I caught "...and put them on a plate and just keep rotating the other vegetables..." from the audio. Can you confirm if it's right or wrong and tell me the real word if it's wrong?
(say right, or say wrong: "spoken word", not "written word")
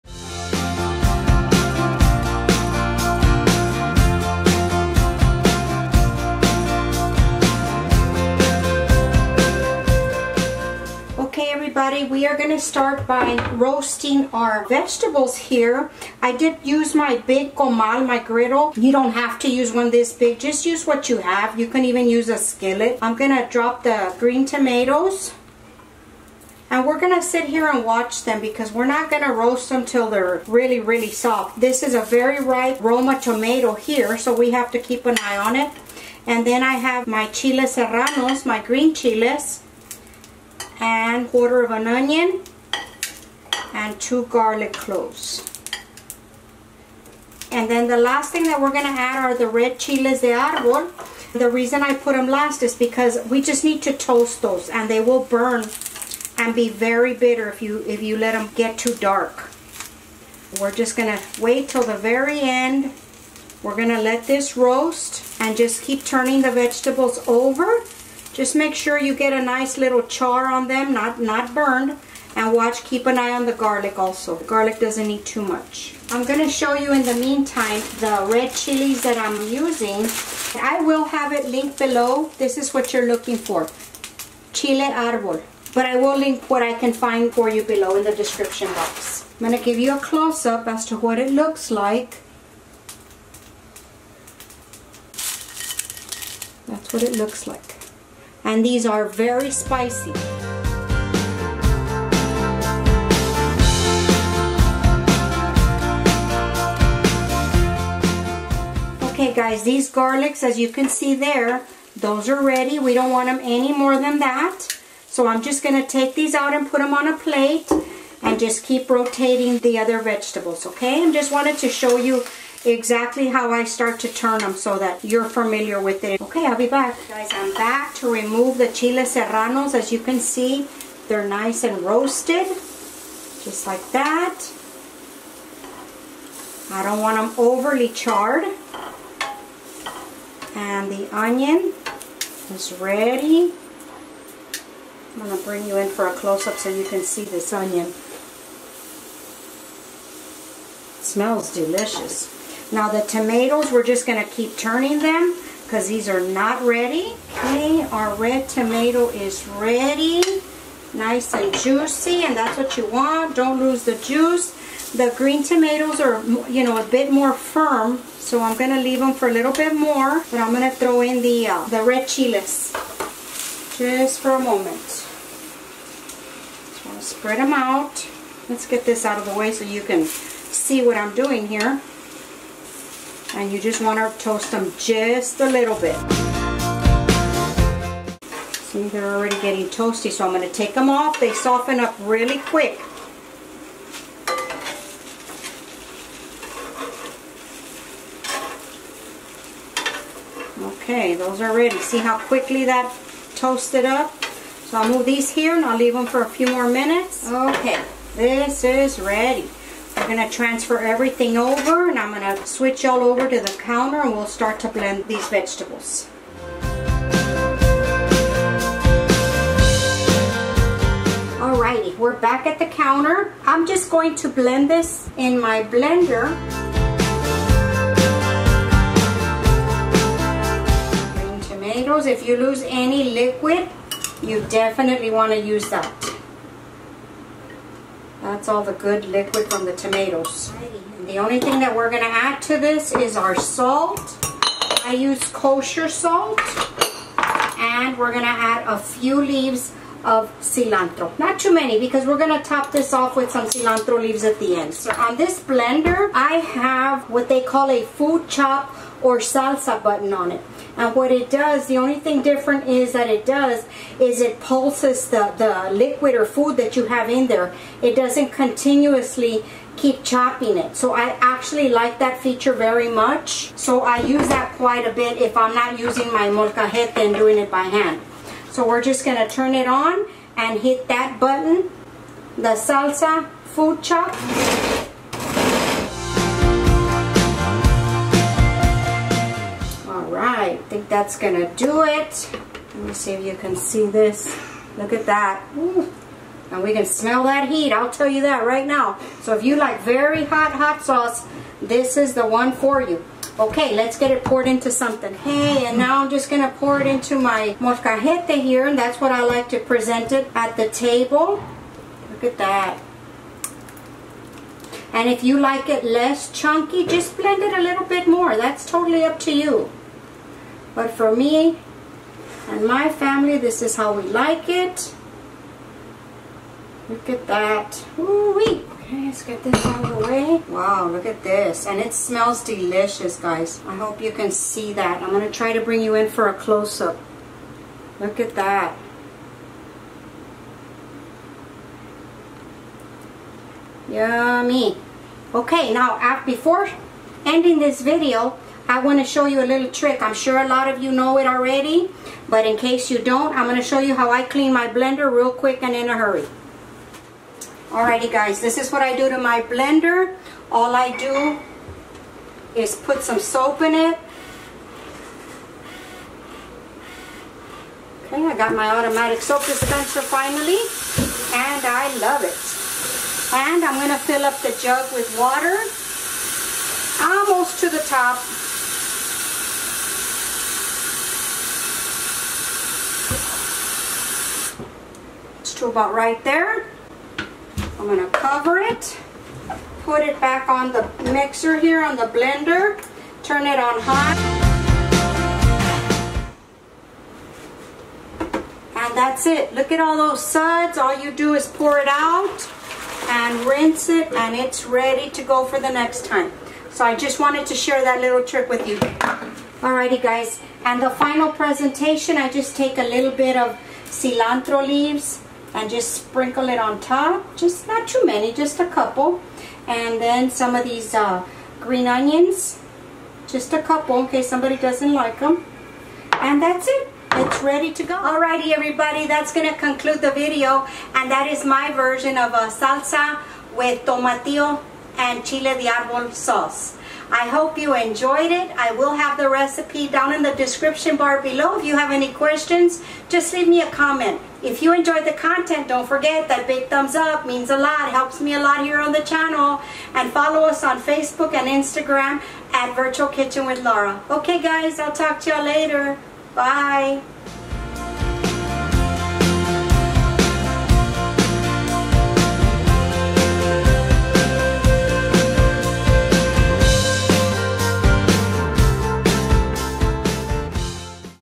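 right.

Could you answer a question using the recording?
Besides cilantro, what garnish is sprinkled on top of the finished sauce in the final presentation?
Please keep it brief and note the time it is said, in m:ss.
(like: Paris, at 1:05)
green onions, at 7:01.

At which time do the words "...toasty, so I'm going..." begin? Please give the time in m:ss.
3:09.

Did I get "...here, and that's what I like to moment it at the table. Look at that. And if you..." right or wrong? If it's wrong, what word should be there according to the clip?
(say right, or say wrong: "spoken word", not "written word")
wrong: "present", not "moment".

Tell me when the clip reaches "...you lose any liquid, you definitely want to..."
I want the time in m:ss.
3:52.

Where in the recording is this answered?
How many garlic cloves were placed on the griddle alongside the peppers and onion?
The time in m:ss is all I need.
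0:44.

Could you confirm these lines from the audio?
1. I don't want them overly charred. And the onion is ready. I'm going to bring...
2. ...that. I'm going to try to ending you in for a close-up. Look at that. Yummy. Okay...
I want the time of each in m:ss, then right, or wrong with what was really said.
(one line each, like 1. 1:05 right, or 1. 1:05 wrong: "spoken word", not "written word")
1. 2:16 right
2. 5:34 wrong: "bring", not "ending".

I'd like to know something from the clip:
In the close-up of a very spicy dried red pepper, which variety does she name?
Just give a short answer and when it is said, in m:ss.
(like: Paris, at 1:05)
Chile arbol, at 1:24.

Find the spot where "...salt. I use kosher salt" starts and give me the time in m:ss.
4:03.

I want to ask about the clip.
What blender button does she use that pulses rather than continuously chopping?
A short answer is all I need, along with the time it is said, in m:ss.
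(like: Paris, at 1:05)
salsa food chop, at 4:42.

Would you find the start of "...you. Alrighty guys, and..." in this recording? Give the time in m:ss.
6:48.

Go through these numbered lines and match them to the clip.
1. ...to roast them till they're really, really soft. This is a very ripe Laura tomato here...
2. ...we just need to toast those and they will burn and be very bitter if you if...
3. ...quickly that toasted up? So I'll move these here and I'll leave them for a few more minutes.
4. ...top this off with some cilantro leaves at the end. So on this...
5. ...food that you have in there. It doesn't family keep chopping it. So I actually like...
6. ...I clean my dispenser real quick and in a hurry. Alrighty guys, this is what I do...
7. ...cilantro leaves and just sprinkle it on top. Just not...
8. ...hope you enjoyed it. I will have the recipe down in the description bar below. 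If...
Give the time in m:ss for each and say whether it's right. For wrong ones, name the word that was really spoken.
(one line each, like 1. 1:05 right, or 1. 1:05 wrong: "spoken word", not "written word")
1. 0:29 wrong: "Roma", not "Laura"
2. 0:53 right
3. 3:22 right
4. 4:12 right
5. 4:26 wrong: "continuously", not "family"
6. 5:54 wrong: "blender", not "dispenser"
7. 6:53 right
8. 7:17 right.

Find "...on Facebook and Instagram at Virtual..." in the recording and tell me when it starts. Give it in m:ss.
7:30.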